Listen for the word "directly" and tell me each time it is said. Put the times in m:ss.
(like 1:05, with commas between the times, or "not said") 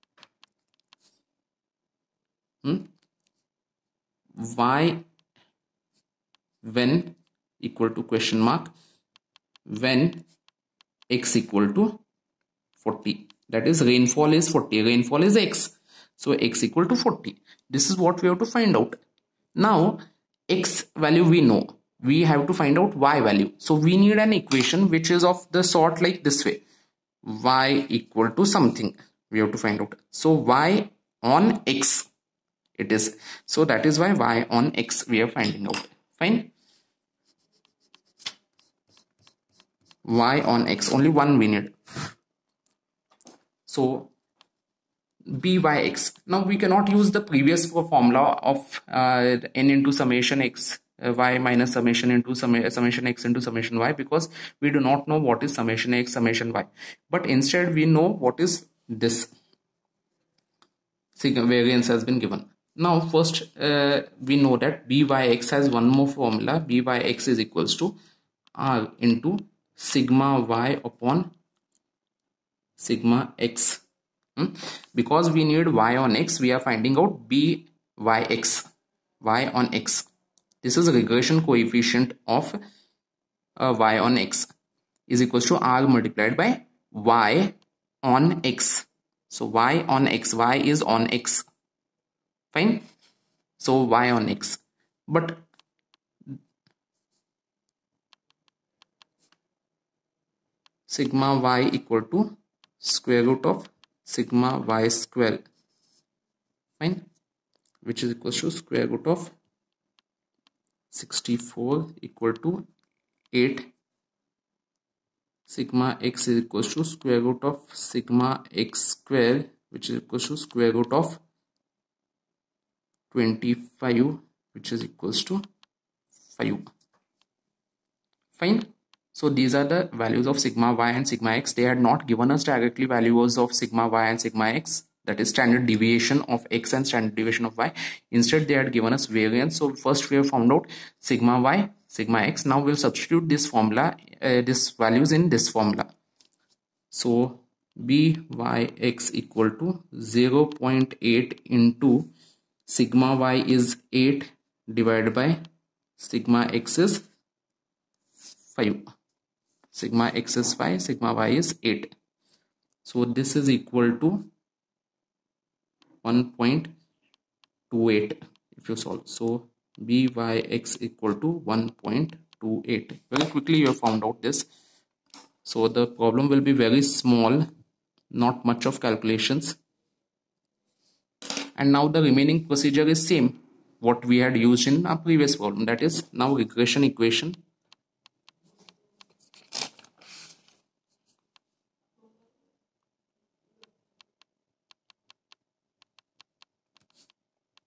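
2:12.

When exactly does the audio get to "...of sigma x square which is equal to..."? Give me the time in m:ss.
1:57.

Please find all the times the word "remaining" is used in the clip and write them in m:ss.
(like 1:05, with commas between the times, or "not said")
3:02.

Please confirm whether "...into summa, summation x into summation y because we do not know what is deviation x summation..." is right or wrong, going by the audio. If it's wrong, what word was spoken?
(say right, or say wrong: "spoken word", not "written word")
wrong: "summation", not "deviation".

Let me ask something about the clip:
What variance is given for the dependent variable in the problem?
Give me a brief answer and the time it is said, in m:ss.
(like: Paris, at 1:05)
64, at 1:51.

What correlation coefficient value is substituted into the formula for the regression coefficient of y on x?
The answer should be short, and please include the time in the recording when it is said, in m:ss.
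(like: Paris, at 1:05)
0.8, at 2:30.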